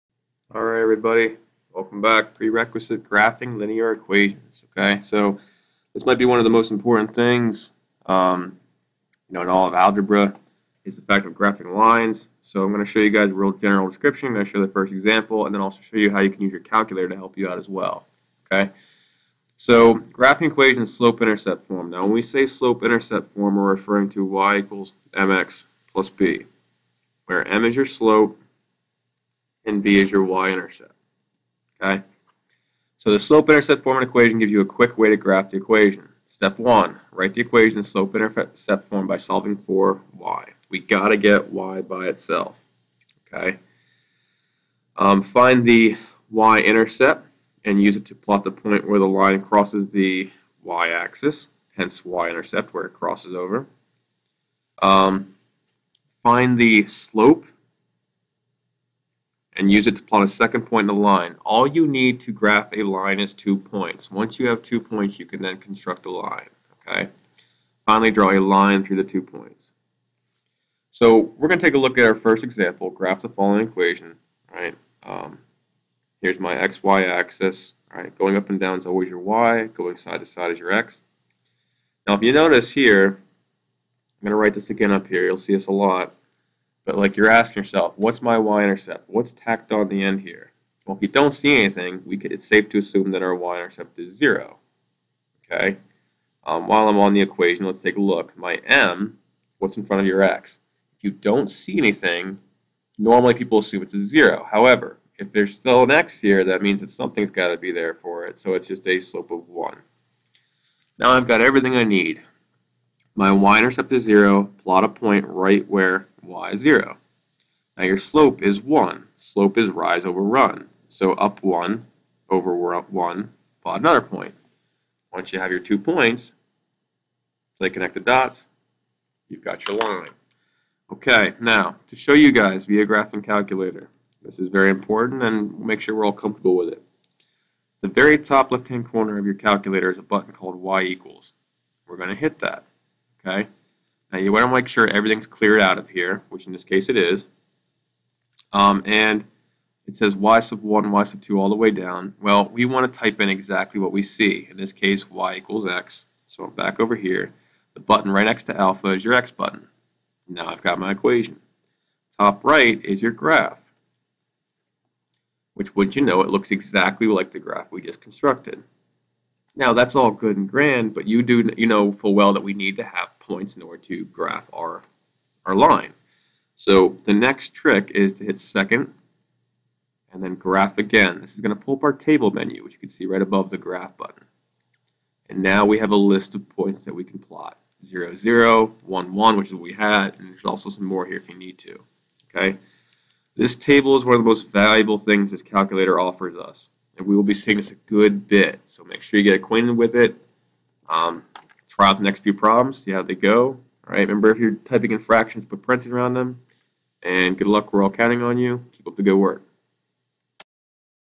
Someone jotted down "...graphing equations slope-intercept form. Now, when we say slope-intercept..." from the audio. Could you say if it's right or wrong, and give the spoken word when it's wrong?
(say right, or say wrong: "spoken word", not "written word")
right.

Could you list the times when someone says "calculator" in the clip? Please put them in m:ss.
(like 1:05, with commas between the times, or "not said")
0:16, 2:13, 2:19, 3:15.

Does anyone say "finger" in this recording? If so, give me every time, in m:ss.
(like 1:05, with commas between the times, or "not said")
not said.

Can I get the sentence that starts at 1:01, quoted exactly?
All you need to graph a line is two points.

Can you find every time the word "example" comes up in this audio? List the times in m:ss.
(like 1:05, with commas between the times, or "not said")
0:14, 1:12.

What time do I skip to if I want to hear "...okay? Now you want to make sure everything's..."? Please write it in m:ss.
2:23.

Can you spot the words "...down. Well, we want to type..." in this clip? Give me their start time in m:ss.
2:31.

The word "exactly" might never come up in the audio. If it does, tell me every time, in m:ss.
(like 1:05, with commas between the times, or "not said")
2:33, 2:46.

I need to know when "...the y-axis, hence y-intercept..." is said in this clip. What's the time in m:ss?
0:49.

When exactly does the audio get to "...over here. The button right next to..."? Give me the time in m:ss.
2:36.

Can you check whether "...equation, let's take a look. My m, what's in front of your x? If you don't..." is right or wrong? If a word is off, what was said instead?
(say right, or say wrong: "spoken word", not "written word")
right.